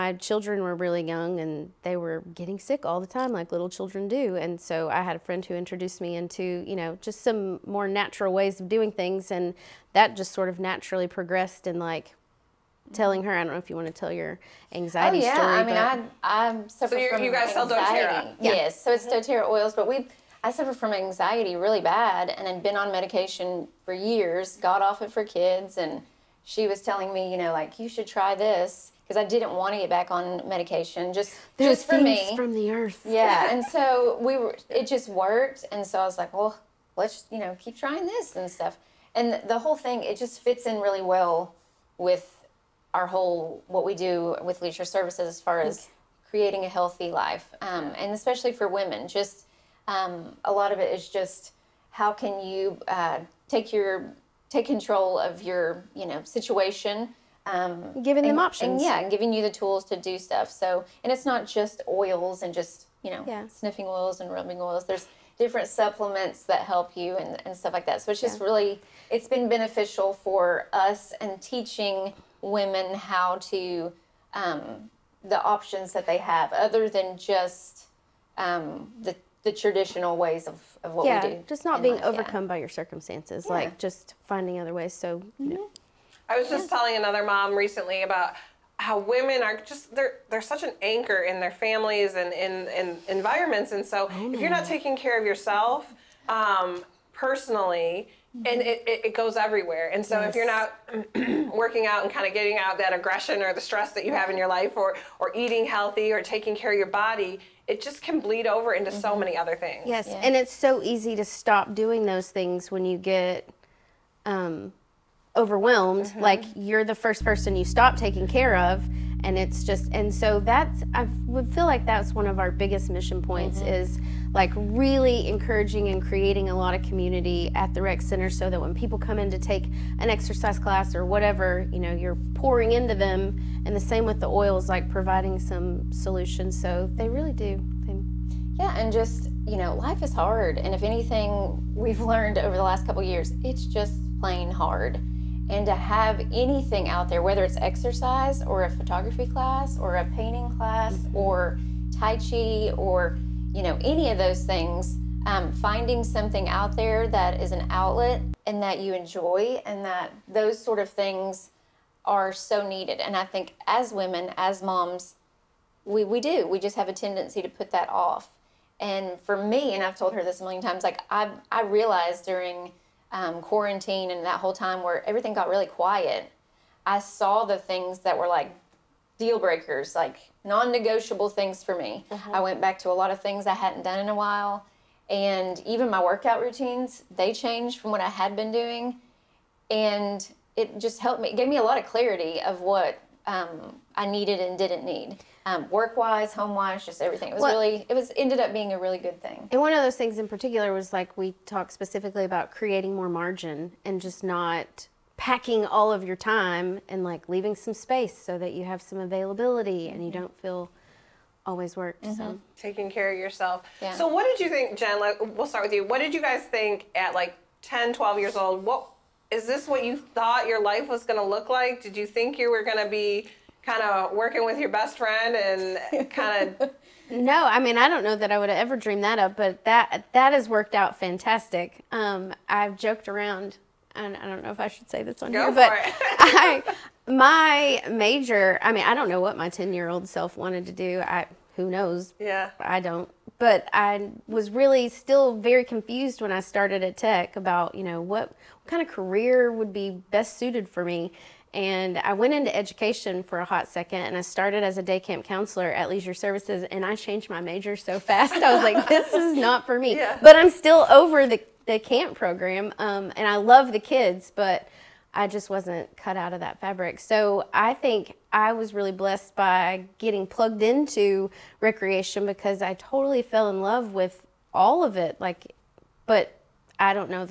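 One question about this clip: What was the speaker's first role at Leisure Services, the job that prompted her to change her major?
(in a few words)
day camp counselor.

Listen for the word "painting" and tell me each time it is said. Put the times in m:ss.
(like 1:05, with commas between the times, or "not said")
2:30.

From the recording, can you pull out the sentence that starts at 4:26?
So I think I was really blessed by getting plugged into recreation because I totally fell in love with all of it.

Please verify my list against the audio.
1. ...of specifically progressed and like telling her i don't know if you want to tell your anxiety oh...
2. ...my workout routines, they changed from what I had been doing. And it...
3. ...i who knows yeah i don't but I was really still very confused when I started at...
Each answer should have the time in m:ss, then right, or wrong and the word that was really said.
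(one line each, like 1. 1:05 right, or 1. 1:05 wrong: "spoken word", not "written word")
1. 0:10 wrong: "naturally", not "specifically"
2. 3:05 right
3. 4:01 right.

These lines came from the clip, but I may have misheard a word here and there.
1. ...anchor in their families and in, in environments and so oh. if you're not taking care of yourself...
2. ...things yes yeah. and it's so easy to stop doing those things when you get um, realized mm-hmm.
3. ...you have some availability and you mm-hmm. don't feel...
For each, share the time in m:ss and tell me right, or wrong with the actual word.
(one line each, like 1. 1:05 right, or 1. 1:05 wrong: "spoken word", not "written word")
1. 1:30 right
2. 1:49 wrong: "overwhelmed", not "realized"
3. 3:28 right.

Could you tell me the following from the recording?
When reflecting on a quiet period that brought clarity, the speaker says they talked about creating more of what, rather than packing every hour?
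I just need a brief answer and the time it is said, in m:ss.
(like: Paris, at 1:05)
margin, at 3:23.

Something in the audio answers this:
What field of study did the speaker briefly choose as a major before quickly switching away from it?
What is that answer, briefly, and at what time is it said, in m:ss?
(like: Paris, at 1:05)
education, at 4:12.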